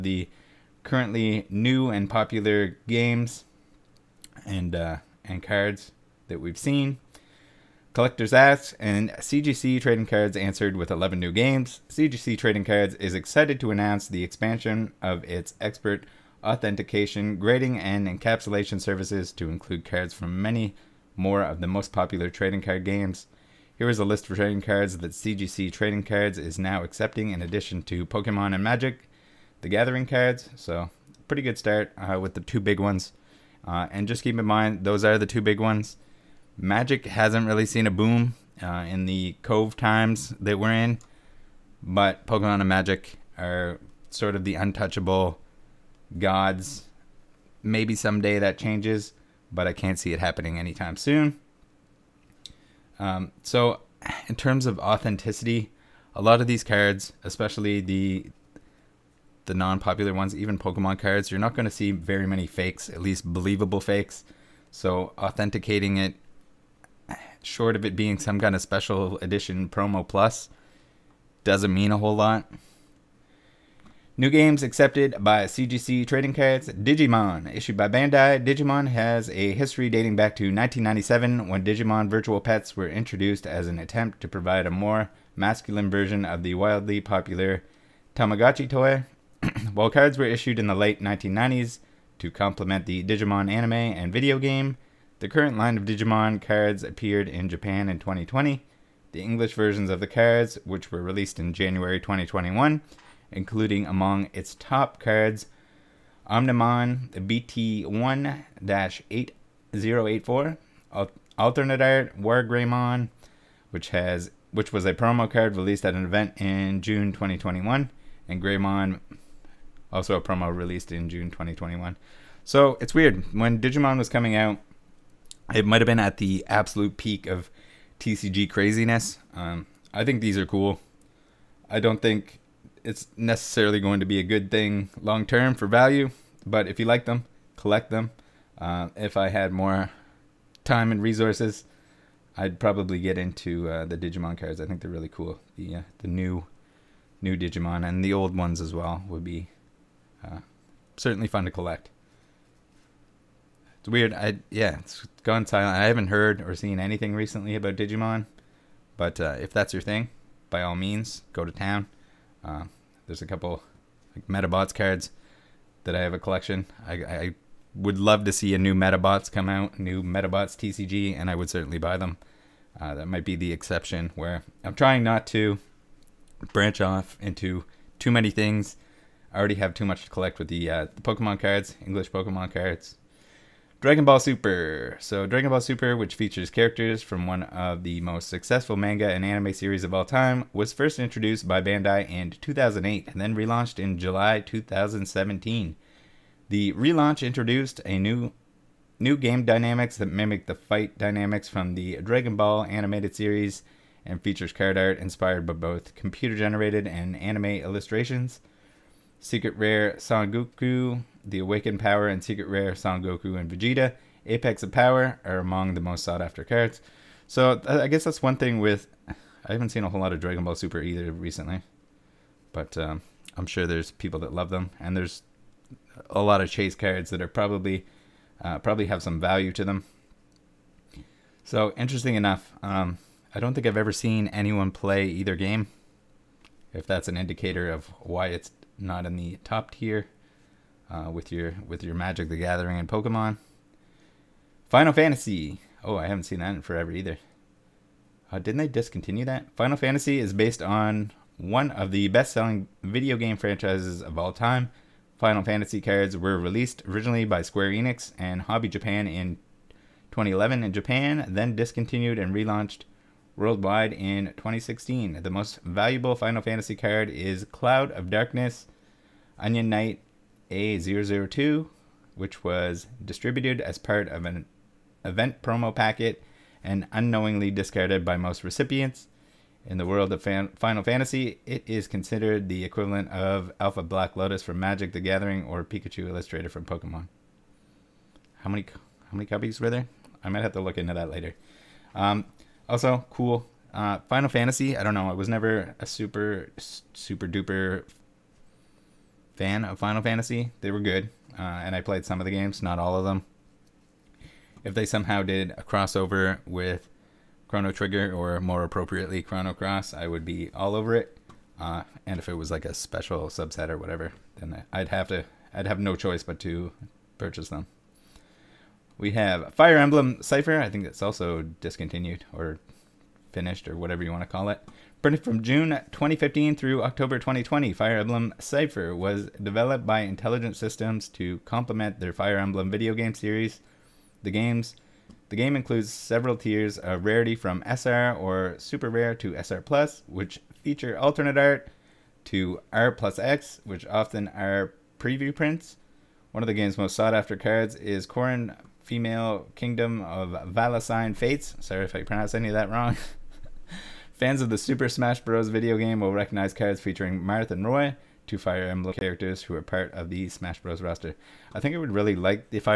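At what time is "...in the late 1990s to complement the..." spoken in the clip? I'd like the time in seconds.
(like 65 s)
90 s.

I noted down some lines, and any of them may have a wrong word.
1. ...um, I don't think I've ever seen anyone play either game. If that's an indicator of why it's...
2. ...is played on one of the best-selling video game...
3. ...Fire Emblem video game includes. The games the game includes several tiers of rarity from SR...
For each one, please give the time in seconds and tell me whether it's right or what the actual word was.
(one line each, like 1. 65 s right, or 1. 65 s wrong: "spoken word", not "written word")
1. 232 s right
2. 250 s wrong: "based", not "played"
3. 332 s wrong: "series", not "includes".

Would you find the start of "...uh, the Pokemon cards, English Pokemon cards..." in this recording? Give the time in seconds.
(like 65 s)
180 s.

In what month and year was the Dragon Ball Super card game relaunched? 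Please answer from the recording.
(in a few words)
July 2017.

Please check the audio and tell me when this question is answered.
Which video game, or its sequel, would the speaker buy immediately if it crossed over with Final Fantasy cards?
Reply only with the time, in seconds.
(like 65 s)
307 s.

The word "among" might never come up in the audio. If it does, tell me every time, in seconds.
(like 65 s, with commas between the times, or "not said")
103 s, 215 s.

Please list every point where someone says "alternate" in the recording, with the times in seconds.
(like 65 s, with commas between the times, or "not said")
111 s, 340 s.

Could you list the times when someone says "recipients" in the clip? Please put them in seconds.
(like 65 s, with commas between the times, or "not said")
278 s.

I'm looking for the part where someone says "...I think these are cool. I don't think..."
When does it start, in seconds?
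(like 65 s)
129 s.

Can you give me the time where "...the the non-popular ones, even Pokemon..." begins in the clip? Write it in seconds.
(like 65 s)
57 s.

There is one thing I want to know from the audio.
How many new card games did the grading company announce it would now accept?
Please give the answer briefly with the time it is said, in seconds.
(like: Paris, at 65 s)
11, at 10 s.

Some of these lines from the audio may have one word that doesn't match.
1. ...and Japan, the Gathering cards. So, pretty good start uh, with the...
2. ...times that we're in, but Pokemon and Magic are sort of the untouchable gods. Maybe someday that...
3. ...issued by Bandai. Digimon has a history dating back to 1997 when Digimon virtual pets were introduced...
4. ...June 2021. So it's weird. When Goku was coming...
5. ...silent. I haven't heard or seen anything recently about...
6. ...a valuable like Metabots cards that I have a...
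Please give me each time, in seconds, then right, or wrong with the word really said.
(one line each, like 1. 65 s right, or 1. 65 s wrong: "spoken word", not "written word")
1. 28 s wrong: "Magic", not "Japan"
2. 39 s right
3. 77 s right
4. 121 s wrong: "Digimon", not "Goku"
5. 155 s right
6. 163 s wrong: "couple", not "valuable".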